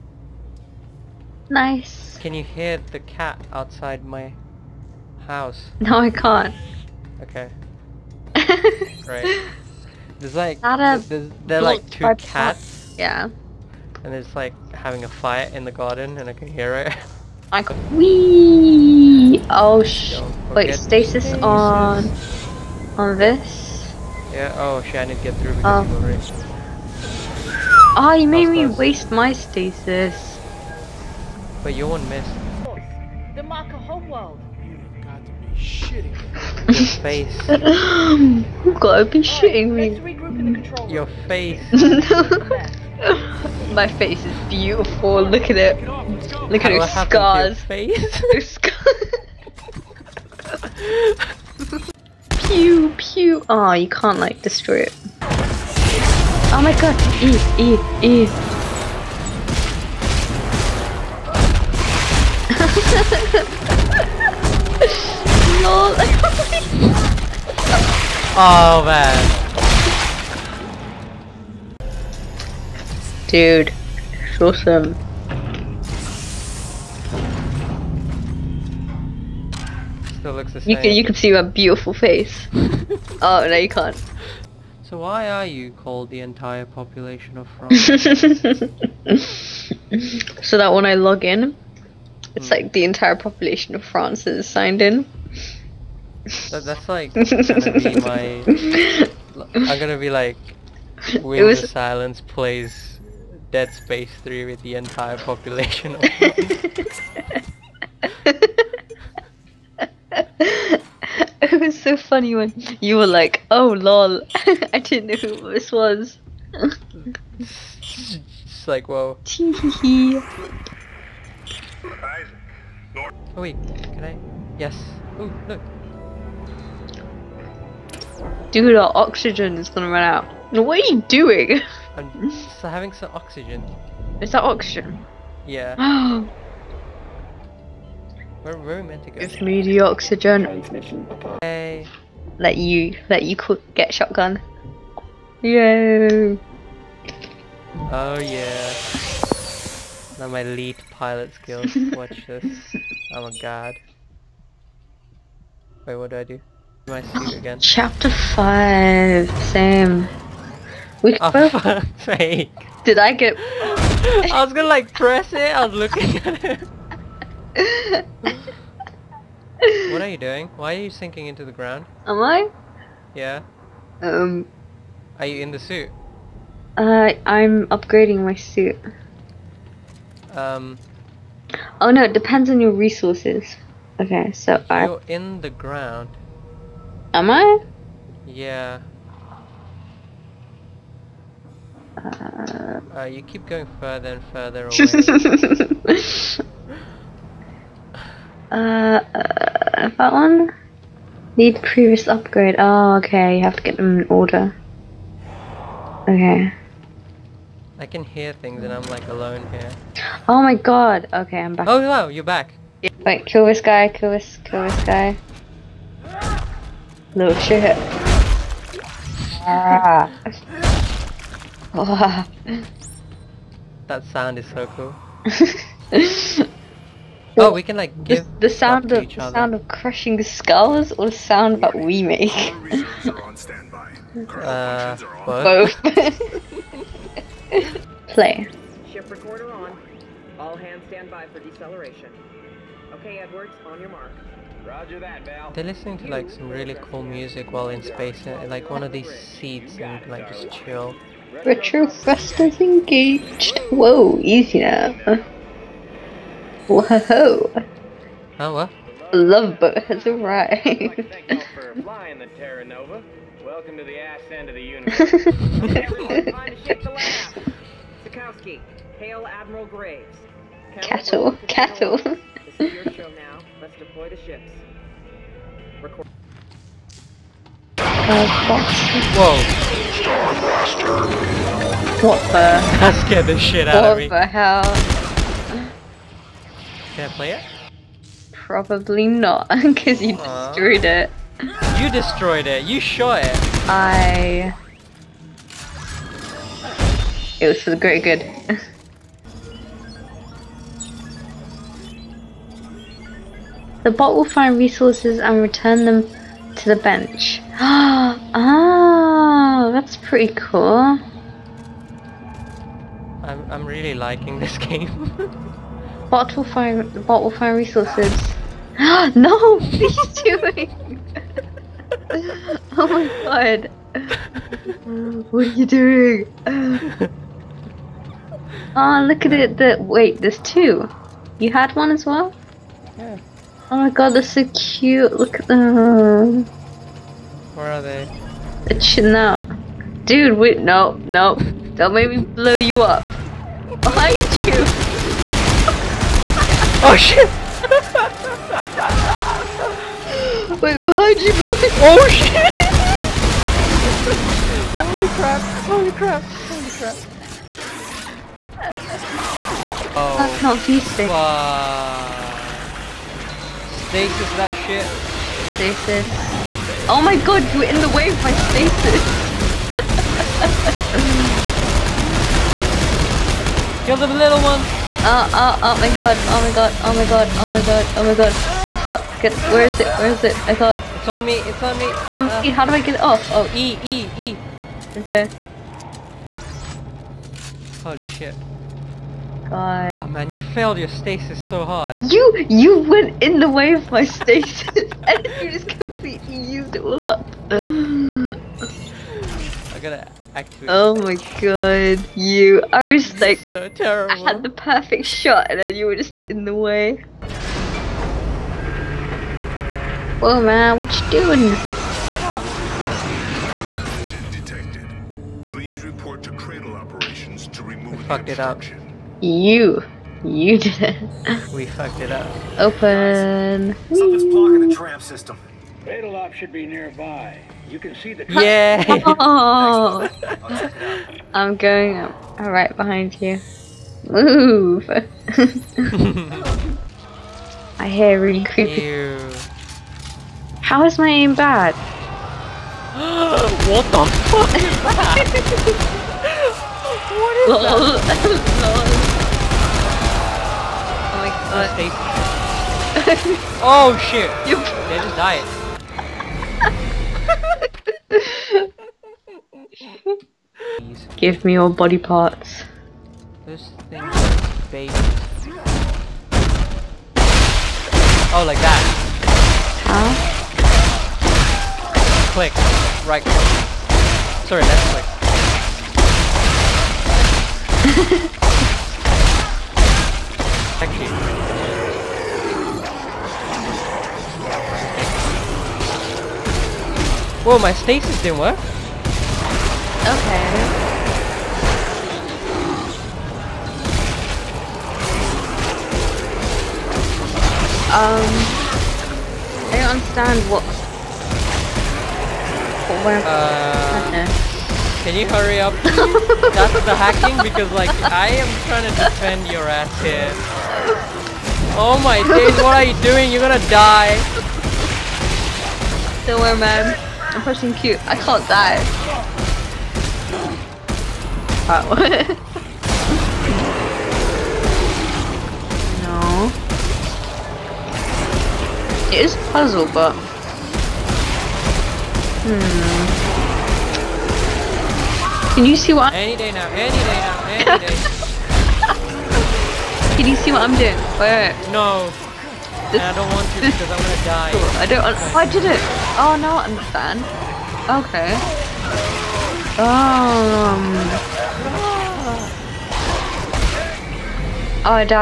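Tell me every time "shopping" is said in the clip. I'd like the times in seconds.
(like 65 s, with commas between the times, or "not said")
not said.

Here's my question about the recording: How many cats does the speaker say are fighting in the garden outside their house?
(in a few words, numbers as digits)
2.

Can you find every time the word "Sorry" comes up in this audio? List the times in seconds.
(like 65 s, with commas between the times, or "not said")
474 s.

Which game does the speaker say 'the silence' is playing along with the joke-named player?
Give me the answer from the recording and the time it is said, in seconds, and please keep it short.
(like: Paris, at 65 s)
Dead Space 3, at 103 s.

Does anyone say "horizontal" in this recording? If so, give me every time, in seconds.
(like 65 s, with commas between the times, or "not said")
not said.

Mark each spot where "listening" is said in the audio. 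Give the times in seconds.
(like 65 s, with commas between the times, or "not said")
245 s.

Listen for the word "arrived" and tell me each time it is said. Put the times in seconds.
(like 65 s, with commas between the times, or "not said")
260 s.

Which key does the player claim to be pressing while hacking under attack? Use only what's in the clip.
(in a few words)
Q.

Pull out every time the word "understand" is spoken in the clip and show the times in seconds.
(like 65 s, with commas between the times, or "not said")
499 s, 546 s.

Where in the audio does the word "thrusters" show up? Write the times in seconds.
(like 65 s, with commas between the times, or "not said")
251 s.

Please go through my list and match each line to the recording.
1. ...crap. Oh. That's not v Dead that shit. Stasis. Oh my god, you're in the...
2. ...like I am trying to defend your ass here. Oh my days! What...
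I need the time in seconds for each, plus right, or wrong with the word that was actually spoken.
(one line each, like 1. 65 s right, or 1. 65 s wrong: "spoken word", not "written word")
1. 356 s wrong: "Stasis", not "Dead"
2. 507 s right.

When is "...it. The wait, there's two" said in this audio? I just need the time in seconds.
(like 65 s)
329 s.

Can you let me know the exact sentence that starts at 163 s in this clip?
I was gonna like press it, I was looking at it what are you doing?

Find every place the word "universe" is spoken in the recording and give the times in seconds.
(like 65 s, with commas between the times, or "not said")
264 s.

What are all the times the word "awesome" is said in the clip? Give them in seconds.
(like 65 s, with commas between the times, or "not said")
74 s.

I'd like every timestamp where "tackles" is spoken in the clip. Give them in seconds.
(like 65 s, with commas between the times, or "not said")
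not said.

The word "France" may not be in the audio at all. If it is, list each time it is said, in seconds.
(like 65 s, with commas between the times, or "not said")
87 s, 93 s, 106 s.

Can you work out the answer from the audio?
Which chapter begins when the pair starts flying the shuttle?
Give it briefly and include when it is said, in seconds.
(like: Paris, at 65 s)
Chapter 5, at 157 s.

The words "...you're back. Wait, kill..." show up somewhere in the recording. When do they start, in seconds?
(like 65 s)
212 s.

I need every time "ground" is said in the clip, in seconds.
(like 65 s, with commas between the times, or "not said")
171 s, 185 s.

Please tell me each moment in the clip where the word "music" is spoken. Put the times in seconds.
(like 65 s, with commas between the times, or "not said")
247 s.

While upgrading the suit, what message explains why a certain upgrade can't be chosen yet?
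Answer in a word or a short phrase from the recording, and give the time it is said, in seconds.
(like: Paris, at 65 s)
Need previous upgrade, at 201 s.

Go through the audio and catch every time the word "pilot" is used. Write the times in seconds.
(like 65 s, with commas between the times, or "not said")
150 s.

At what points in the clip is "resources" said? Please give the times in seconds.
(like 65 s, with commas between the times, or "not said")
182 s, 304 s, 317 s.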